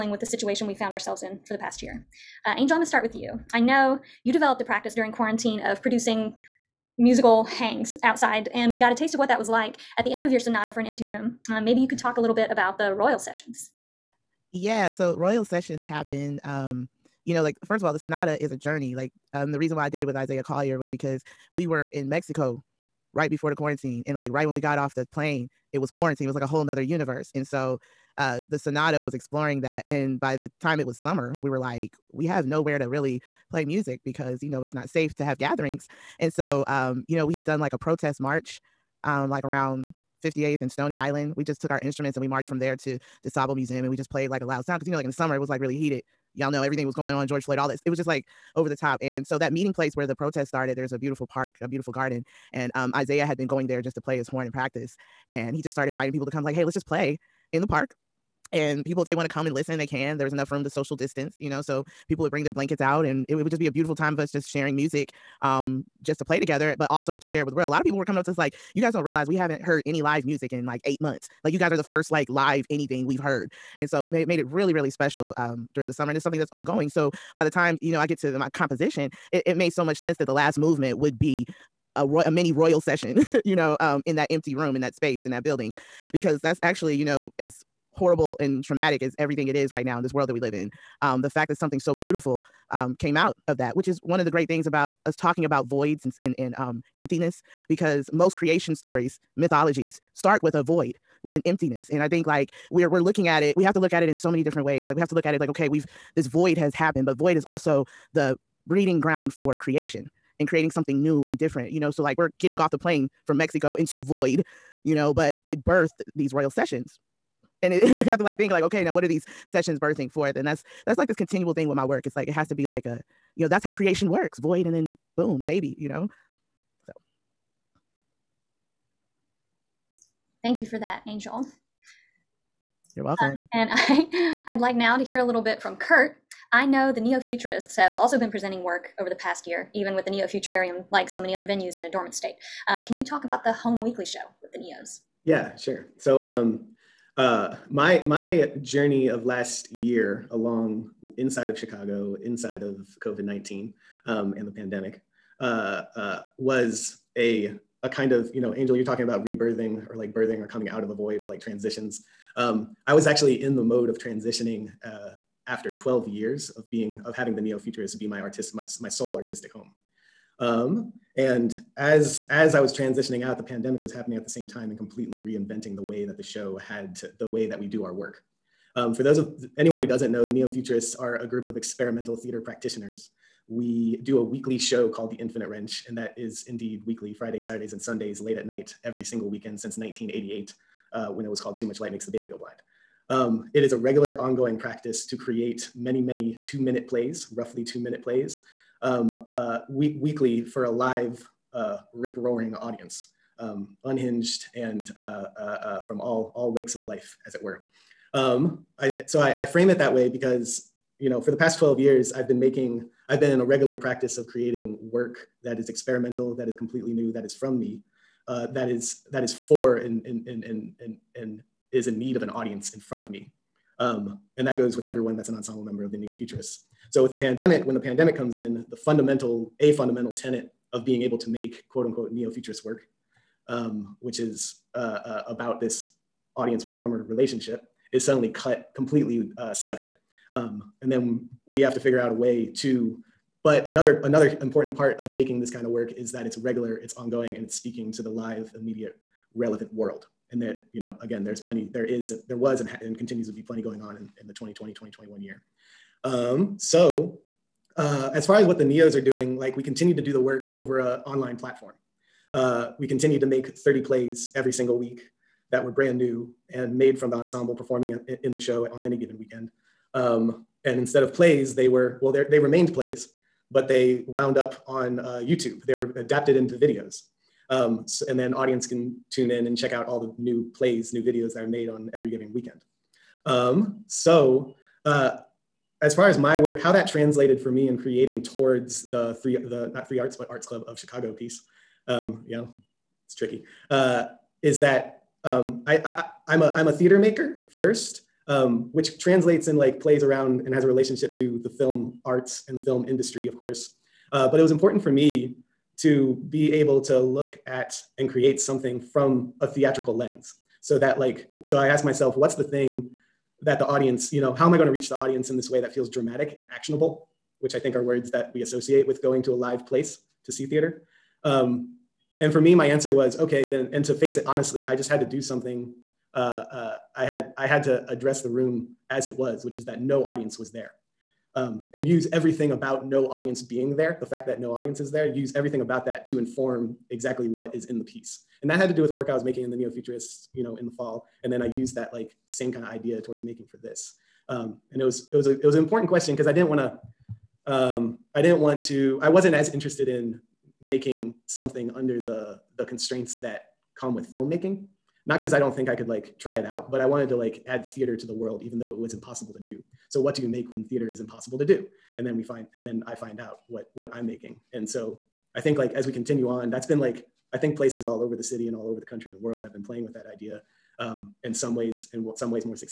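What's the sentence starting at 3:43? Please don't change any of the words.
Um, and that goes with everyone that's an ensemble member of the Neo Futurists.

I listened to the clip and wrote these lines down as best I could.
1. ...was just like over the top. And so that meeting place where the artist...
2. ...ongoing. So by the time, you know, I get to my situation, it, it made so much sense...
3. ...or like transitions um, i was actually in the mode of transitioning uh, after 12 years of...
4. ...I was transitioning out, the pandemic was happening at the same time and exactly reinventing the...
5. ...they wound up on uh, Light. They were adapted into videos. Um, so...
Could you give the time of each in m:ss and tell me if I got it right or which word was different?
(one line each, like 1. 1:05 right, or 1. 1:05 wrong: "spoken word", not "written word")
1. 0:47 wrong: "protest", not "artist"
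2. 1:16 wrong: "composition", not "situation"
3. 2:41 right
4. 2:52 wrong: "completely", not "exactly"
5. 4:33 wrong: "YouTube", not "Light".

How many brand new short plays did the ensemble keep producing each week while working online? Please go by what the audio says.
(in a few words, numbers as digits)
30.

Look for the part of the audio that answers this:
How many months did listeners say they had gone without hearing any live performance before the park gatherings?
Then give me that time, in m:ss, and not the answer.
1:10.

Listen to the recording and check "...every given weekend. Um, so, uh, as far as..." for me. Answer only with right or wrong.
right.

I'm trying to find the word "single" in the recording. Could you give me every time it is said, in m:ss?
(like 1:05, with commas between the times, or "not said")
3:09, 4:24.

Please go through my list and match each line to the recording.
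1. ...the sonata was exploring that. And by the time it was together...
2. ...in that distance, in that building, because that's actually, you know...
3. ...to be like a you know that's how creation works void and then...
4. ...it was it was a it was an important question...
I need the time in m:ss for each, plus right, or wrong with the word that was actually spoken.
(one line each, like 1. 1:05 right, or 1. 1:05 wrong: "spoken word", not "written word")
1. 0:28 wrong: "summer", not "together"
2. 1:24 wrong: "space", not "distance"
3. 2:02 right
4. 5:44 right.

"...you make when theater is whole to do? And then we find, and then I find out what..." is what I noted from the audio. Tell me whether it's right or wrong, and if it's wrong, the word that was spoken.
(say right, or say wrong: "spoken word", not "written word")
wrong: "impossible", not "whole".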